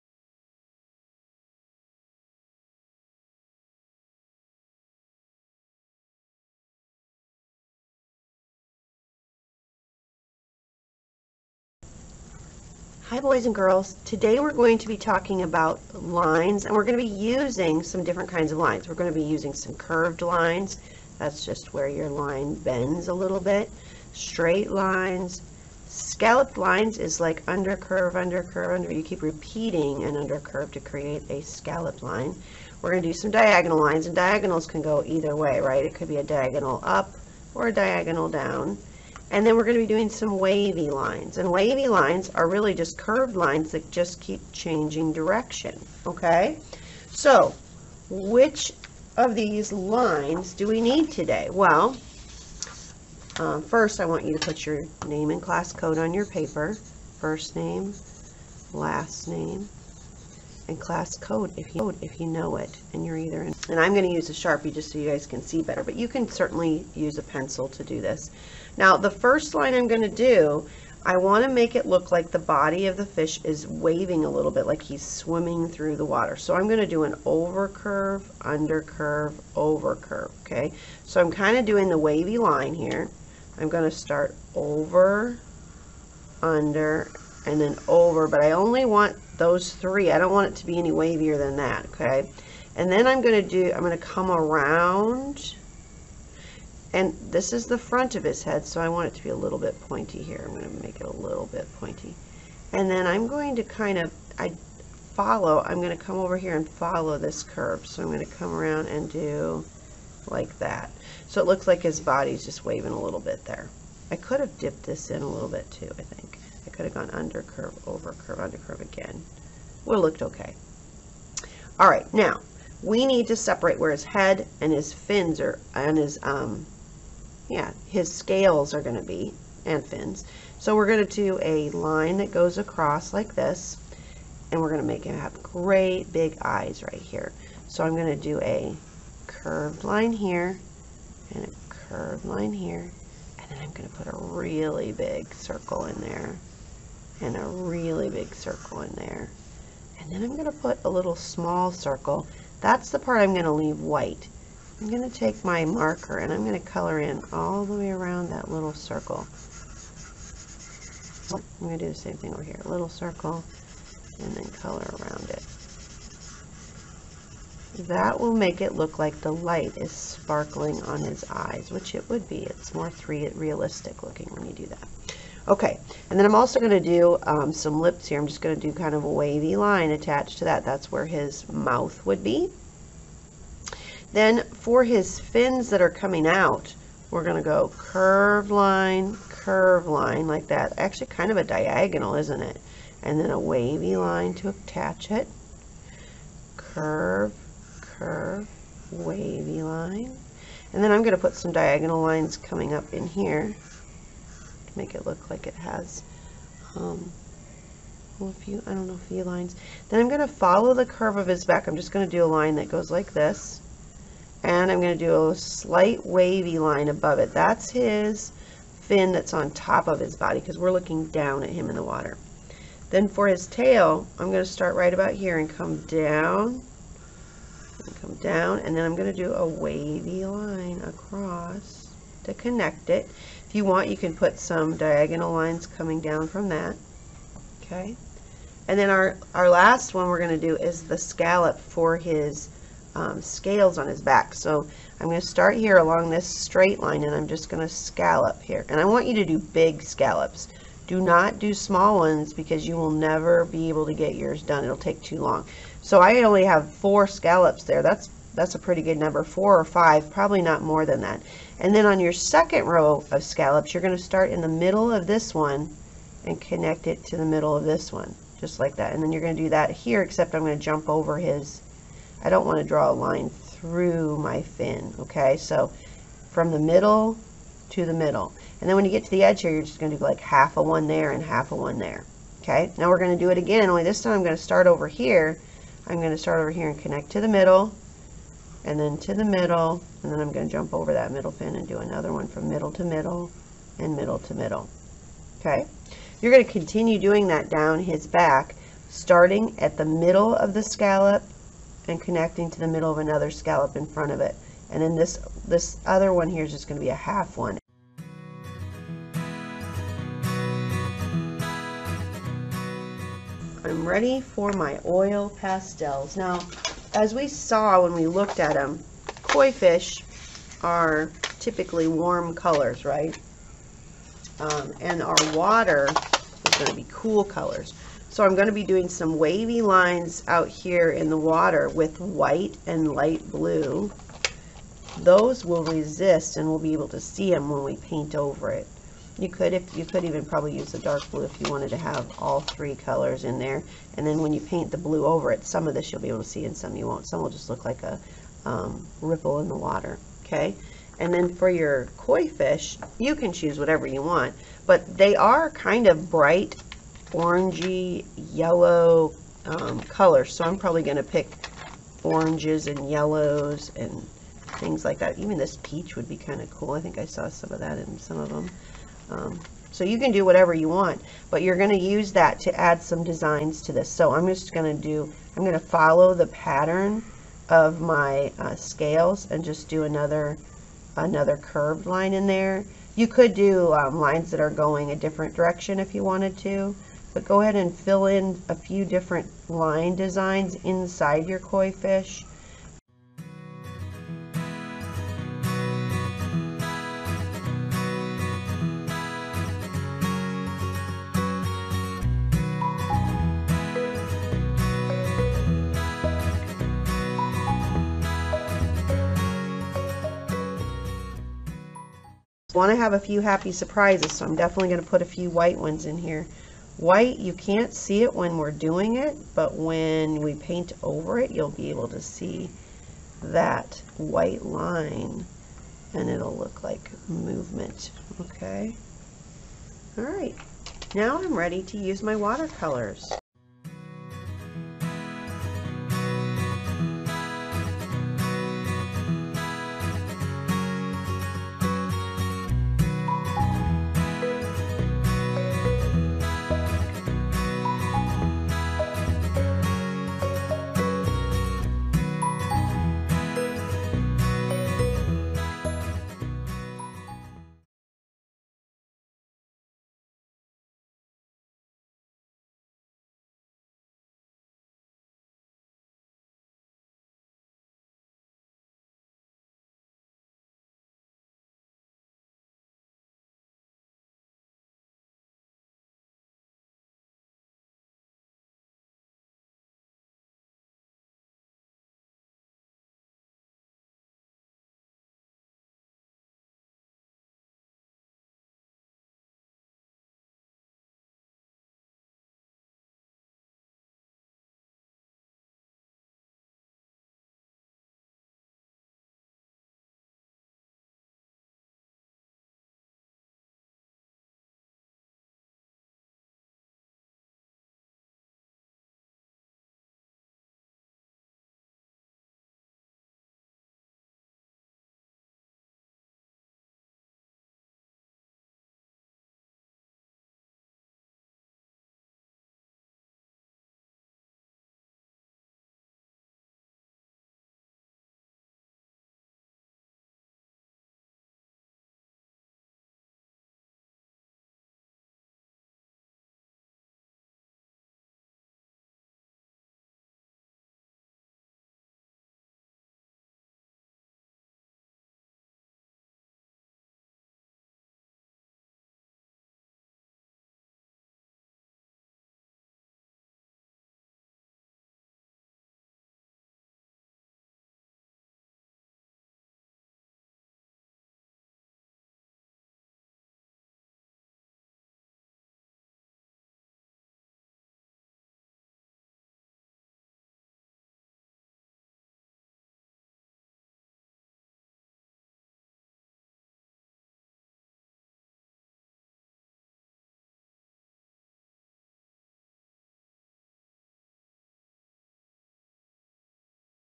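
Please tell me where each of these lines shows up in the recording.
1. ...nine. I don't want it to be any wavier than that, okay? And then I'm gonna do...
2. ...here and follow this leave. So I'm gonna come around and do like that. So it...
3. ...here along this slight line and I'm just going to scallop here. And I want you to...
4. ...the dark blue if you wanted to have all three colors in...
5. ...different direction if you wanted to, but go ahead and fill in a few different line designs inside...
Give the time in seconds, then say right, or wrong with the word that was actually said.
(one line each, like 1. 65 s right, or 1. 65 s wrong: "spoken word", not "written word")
1. 89 s wrong: "three", not "nine"
2. 106 s wrong: "curve", not "leave"
3. 245 s wrong: "straight", not "slight"
4. 340 s right
5. 384 s right.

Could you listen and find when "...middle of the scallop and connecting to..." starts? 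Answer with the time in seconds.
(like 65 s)
299 s.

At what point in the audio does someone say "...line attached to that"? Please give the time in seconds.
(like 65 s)
179 s.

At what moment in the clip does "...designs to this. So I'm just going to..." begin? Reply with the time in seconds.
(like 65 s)
373 s.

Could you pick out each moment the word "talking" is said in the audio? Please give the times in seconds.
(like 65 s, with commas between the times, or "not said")
14 s.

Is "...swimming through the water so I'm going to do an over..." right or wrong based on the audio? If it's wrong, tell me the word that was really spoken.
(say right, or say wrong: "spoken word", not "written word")
right.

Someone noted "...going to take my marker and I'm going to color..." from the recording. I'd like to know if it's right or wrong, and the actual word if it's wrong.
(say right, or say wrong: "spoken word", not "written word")
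right.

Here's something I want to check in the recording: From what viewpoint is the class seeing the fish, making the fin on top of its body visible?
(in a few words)
Looking down at him.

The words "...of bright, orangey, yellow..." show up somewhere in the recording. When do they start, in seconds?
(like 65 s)
355 s.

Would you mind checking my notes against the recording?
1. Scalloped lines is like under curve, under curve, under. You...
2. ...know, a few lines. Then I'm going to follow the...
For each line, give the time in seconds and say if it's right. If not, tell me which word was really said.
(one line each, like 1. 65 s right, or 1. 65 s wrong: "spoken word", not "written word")
1. 25 s right
2. 208 s right.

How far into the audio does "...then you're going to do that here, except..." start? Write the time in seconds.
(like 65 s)
269 s.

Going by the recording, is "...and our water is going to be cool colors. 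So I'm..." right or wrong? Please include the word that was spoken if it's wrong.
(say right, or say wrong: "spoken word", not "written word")
right.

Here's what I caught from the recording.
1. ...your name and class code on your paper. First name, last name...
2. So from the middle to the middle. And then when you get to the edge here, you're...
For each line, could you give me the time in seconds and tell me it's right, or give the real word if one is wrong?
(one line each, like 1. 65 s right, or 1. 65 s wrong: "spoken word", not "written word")
1. 54 s right
2. 275 s right.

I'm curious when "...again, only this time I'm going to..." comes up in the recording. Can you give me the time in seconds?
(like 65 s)
283 s.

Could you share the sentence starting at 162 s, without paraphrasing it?
Little circle and then color around it.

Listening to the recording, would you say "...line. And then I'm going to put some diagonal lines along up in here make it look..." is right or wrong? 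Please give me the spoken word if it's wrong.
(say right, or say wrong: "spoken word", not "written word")
wrong: "coming", not "along".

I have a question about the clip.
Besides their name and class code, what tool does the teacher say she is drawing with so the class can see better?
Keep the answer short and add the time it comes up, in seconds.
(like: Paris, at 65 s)
A sharpie, at 64 s.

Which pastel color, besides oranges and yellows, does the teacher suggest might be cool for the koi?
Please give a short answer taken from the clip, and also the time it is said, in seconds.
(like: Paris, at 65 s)
Peach, at 365 s.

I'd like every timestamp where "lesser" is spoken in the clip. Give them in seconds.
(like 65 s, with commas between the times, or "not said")
not said.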